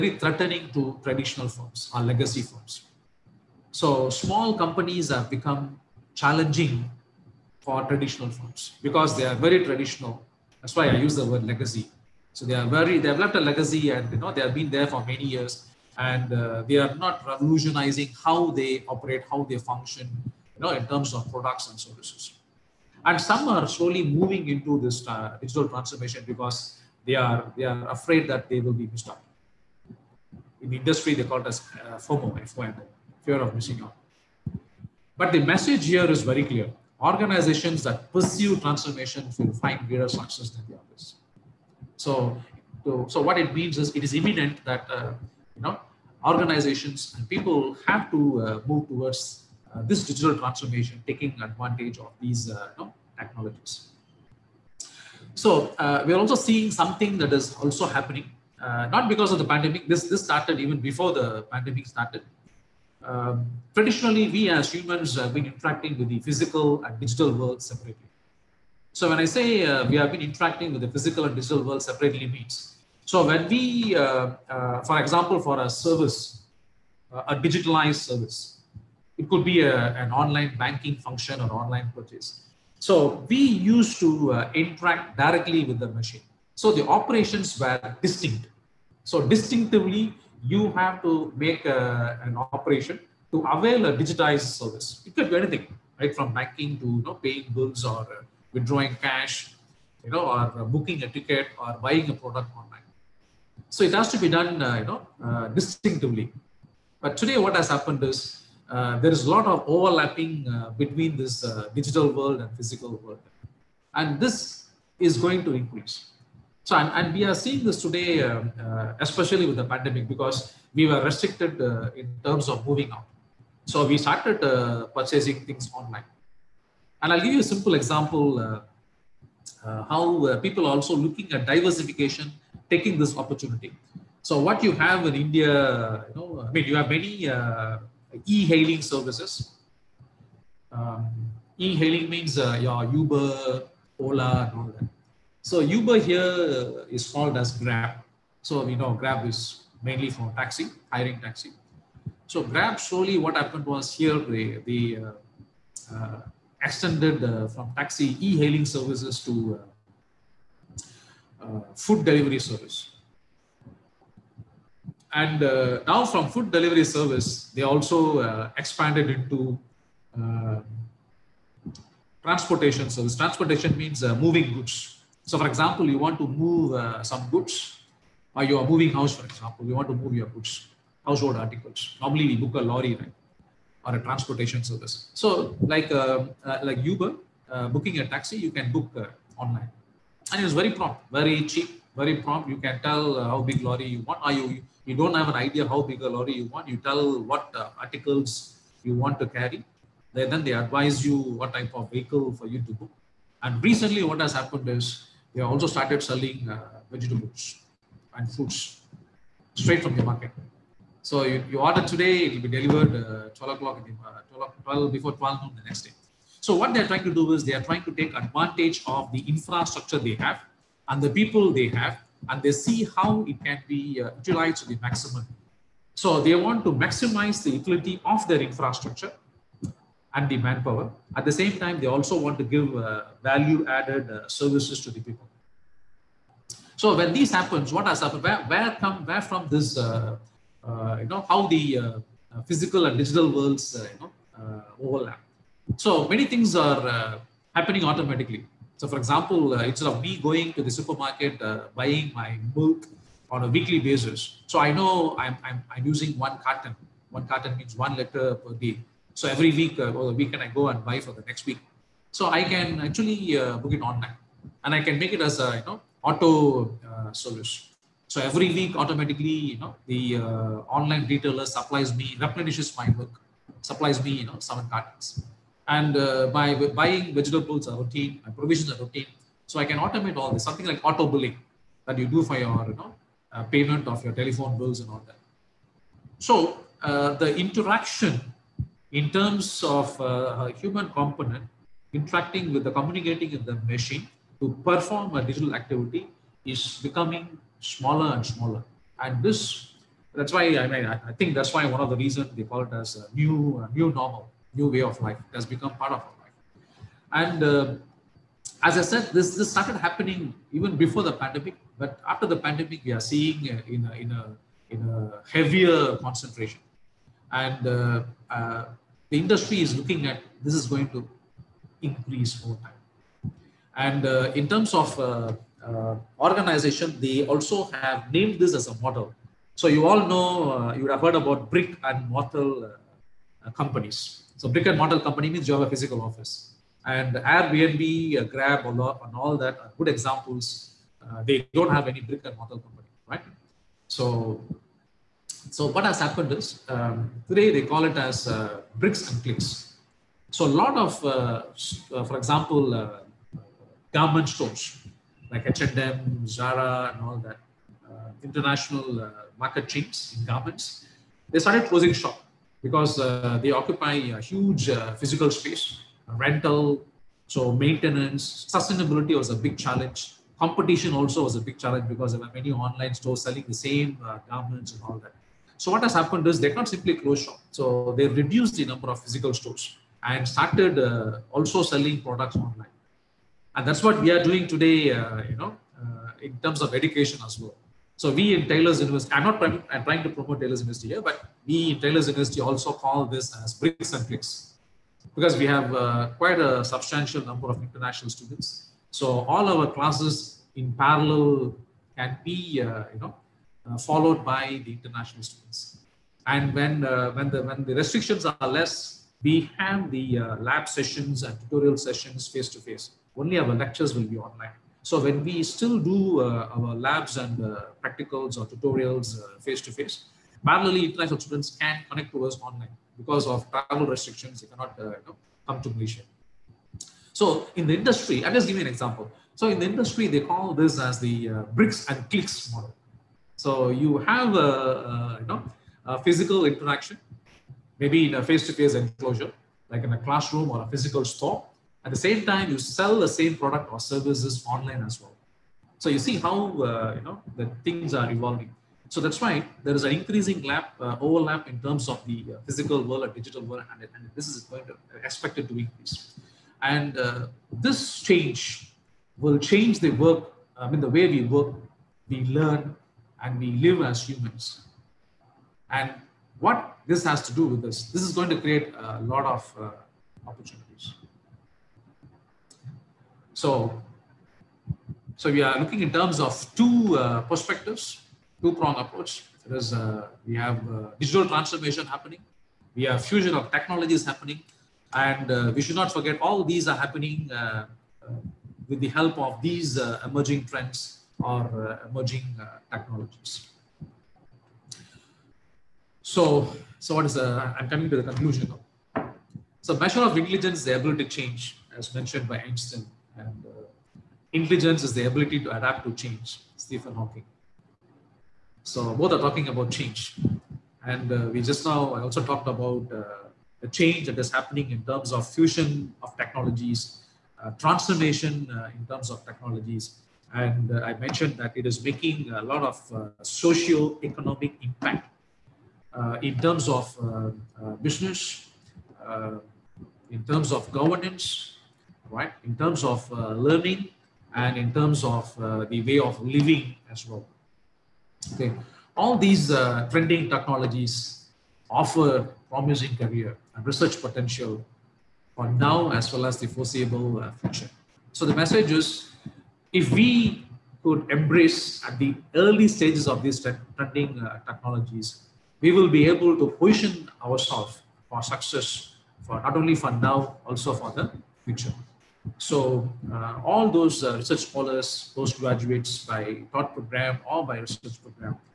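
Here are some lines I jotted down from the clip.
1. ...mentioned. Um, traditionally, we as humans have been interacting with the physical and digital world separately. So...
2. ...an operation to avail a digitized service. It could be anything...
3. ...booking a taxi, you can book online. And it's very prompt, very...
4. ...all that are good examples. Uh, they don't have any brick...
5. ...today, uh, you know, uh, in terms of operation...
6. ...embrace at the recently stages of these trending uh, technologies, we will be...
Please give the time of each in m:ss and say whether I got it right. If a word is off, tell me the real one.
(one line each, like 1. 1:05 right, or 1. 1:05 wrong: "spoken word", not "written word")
1. 1:01 wrong: "started", not "mentioned"
2. 1:32 right
3. 3:07 right
4. 5:38 right
5. 6:24 wrong: "education", not "operation"
6. 9:11 wrong: "early", not "recently".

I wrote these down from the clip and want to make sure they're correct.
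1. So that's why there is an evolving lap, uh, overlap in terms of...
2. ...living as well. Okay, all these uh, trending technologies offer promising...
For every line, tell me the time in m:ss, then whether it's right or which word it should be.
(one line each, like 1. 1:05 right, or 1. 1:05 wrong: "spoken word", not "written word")
1. 7:28 wrong: "increasing", not "evolving"
2. 8:56 right.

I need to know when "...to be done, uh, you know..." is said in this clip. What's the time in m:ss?
1:44.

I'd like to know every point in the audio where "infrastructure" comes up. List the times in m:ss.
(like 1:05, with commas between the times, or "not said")
3:39, 3:48.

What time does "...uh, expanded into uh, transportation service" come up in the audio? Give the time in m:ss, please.
2:48.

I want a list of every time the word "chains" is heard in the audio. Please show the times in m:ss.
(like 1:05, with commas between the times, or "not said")
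5:59.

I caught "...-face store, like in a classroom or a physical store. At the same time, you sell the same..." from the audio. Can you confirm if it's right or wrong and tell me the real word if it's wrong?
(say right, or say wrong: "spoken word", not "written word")
wrong: "enclosure", not "store".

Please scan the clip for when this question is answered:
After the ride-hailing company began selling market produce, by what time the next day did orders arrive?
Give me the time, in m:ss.
3:34.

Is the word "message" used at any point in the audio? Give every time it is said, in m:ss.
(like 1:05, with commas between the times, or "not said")
0:35, 9:08.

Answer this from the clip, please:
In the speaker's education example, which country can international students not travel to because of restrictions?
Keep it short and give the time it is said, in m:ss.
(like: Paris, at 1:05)
Malaysia, at 7:05.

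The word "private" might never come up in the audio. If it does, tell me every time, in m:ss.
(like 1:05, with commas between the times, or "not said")
not said.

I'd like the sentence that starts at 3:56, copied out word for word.
So when this happens, what has happened?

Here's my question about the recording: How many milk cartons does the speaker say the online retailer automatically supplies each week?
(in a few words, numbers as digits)
7.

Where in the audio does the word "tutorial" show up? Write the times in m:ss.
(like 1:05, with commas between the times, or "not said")
6:51, 6:58.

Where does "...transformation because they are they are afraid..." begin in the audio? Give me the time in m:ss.
0:25.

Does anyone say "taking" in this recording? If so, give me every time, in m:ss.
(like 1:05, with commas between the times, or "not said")
0:51, 2:12.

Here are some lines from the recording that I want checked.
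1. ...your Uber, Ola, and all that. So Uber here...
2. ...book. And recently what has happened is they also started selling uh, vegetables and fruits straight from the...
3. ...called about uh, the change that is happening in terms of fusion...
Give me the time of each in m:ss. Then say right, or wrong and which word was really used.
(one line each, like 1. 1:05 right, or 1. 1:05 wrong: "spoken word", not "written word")
1. 2:22 right
2. 3:22 right
3. 8:32 wrong: "talked", not "called".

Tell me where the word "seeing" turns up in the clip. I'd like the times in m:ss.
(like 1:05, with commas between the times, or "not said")
0:56, 1:57, 5:13.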